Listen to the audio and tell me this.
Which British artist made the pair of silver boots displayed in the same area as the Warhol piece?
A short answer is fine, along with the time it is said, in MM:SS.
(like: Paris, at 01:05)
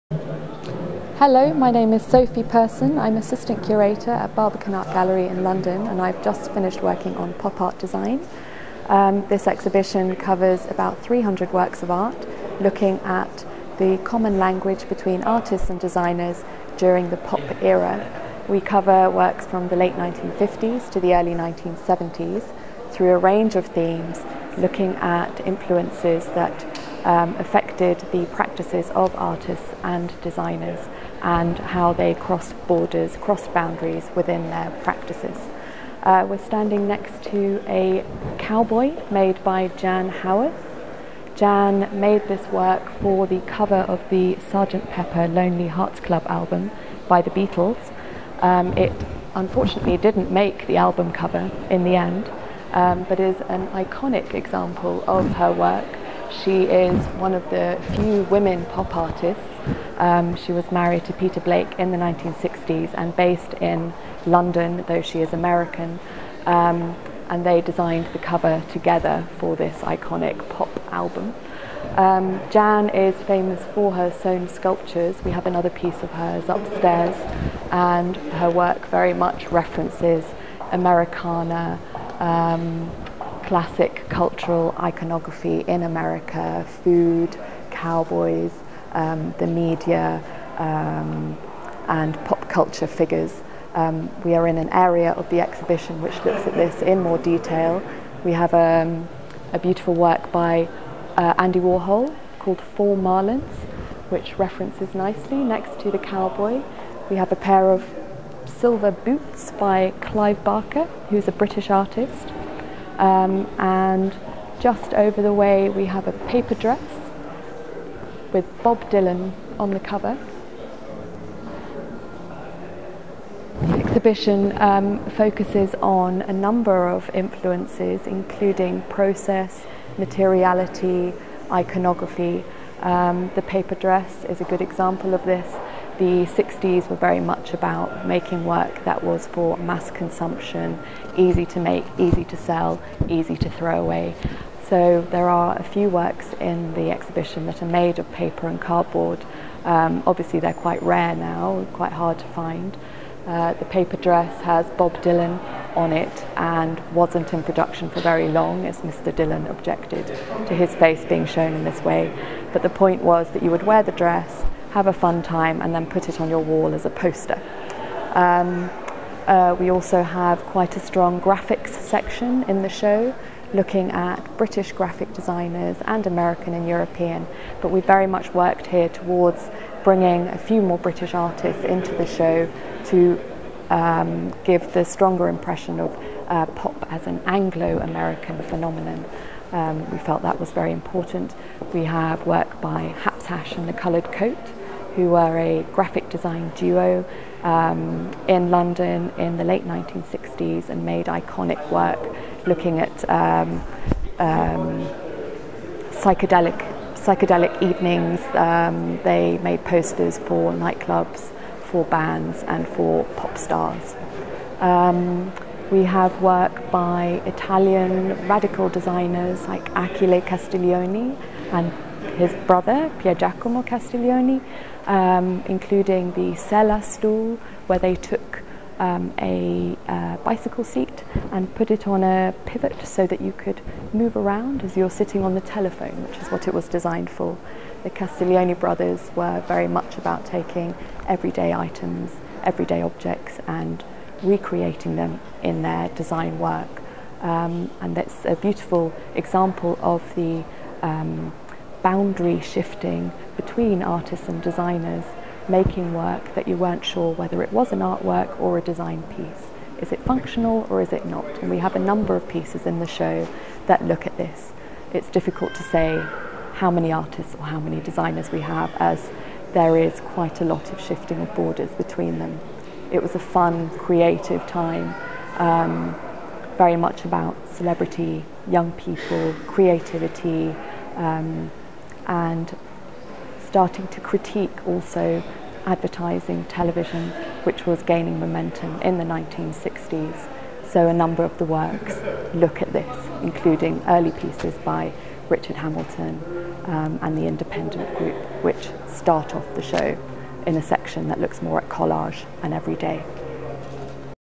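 Clive Barker, at 01:49.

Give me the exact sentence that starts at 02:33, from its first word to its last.
Uh, the paper dress has Bob Dylan on it and wasn't in production for very long, as Mr.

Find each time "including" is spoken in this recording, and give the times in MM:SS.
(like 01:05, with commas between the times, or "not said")
02:08, 03:45, 04:53.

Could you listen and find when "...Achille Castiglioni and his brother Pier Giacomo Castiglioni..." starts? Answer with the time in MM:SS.
03:39.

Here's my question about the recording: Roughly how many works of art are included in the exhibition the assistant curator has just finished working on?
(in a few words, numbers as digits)
300.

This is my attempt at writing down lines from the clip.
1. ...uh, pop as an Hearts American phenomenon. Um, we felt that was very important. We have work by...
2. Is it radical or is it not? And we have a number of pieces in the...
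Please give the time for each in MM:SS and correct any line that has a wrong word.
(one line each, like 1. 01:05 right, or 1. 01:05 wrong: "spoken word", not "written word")
1. 03:06 wrong: "Anglo", not "Hearts"
2. 04:19 wrong: "functional", not "radical".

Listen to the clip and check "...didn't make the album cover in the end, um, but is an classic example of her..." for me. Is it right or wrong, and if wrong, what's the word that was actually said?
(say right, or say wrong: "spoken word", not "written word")
wrong: "iconic", not "classic".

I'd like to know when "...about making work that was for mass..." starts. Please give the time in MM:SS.
02:17.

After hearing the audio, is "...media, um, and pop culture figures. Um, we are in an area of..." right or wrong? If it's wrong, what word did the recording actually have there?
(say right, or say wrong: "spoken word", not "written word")
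right.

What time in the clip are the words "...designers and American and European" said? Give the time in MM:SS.
02:55.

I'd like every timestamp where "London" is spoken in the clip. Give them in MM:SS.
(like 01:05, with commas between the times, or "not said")
00:05, 01:04, 03:18.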